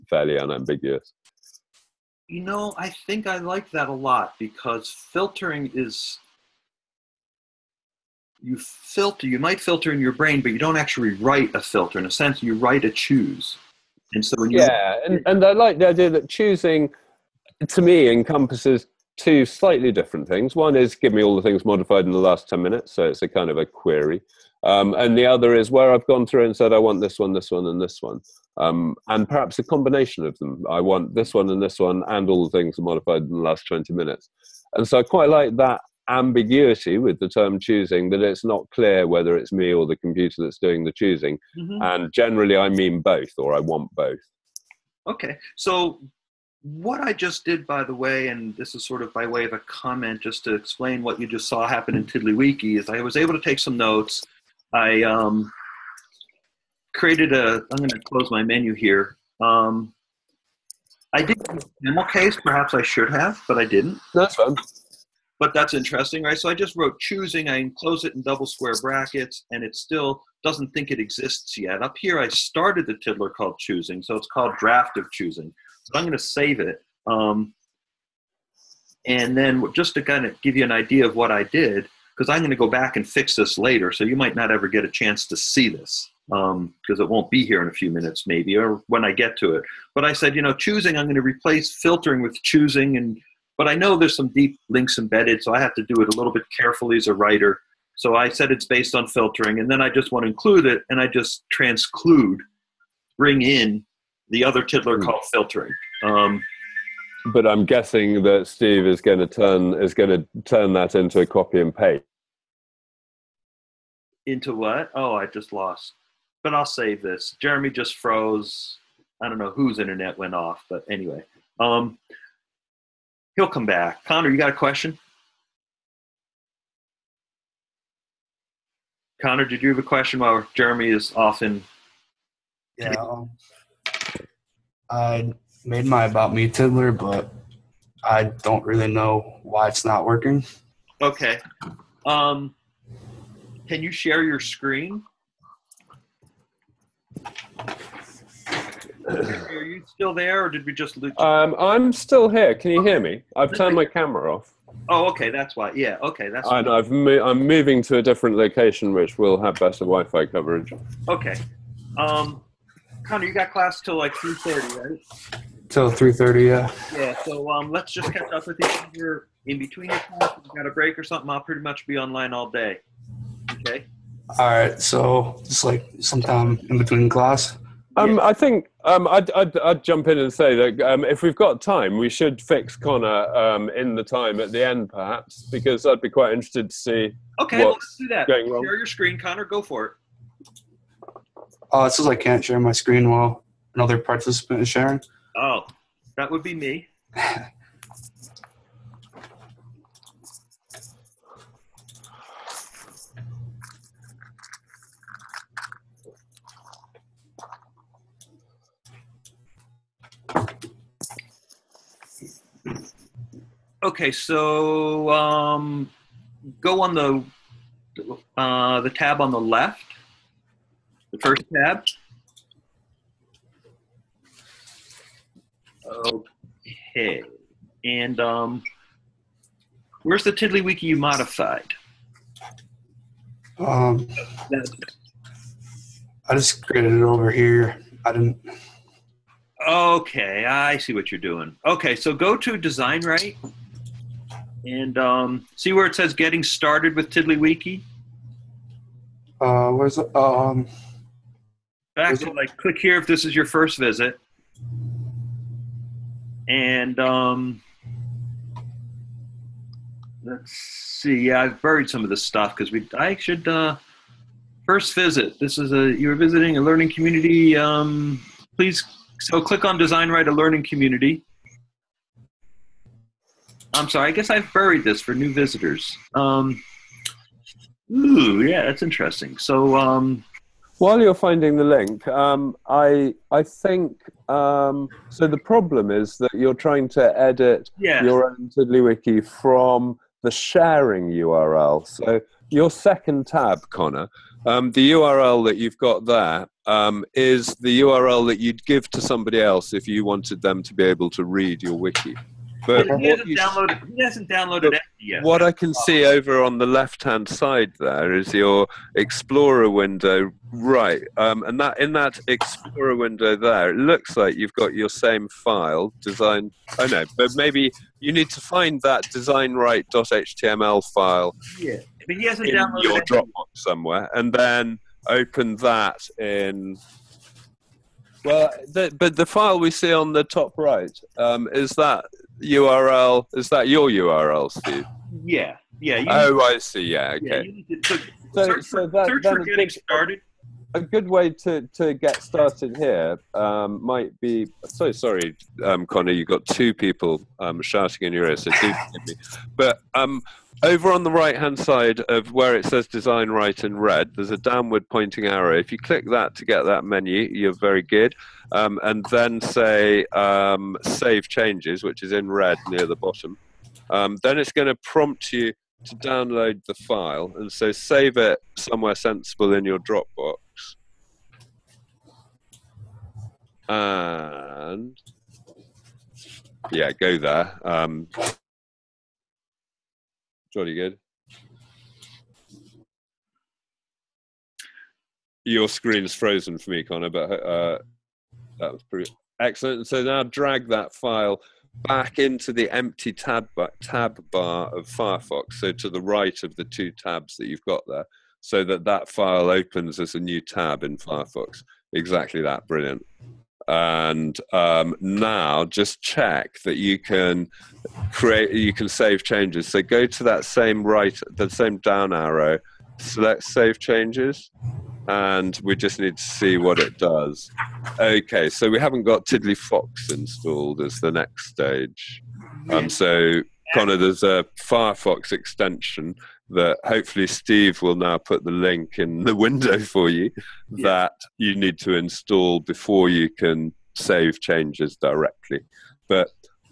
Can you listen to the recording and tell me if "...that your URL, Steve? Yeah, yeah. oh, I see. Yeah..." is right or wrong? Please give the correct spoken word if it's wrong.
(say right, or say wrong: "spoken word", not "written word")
right.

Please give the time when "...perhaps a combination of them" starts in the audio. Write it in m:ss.
0:29.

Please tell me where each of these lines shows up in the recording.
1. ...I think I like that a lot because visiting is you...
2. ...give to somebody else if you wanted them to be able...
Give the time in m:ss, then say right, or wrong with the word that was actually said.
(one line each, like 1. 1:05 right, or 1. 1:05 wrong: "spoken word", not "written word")
1. 0:02 wrong: "filtering", not "visiting"
2. 4:58 right.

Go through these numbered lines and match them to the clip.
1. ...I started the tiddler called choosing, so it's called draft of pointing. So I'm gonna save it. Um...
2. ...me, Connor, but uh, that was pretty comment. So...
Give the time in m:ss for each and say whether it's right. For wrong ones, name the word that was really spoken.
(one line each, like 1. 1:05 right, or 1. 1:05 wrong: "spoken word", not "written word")
1. 1:12 wrong: "choosing", not "pointing"
2. 6:26 wrong: "excellent", not "comment".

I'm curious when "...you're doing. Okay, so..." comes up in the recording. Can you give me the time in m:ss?
4:01.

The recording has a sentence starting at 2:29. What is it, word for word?
Are you still there, or did we just lose?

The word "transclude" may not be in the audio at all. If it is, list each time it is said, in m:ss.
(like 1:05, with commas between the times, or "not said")
1:41.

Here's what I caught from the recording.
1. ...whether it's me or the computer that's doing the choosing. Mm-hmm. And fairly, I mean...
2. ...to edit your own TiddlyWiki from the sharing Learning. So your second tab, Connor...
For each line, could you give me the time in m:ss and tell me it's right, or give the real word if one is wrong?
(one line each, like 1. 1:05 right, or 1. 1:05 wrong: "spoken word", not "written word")
1. 0:39 wrong: "generally", not "fairly"
2. 4:46 wrong: "URL", not "Learning".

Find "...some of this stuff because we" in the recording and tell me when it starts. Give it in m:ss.
4:21.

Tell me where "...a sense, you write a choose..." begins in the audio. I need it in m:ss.
0:12.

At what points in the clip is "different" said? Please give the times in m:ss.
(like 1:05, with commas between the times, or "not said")
0:19, 2:38.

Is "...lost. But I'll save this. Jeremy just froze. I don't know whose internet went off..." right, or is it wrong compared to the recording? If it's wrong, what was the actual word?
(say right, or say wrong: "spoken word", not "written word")
right.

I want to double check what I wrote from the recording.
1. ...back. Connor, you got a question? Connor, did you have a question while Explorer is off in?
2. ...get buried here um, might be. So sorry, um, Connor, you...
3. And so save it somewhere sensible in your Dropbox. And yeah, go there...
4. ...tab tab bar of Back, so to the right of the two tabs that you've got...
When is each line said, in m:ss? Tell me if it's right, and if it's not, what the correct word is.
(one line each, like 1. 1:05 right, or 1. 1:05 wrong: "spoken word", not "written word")
1. 2:03 wrong: "Jeremy", not "Explorer"
2. 5:41 wrong: "started", not "buried"
3. 6:07 right
4. 6:33 wrong: "Firefox", not "Back".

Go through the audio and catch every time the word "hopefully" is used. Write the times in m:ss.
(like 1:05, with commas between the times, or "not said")
7:06.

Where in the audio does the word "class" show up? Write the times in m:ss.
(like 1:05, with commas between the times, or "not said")
2:43, 2:50, 2:57.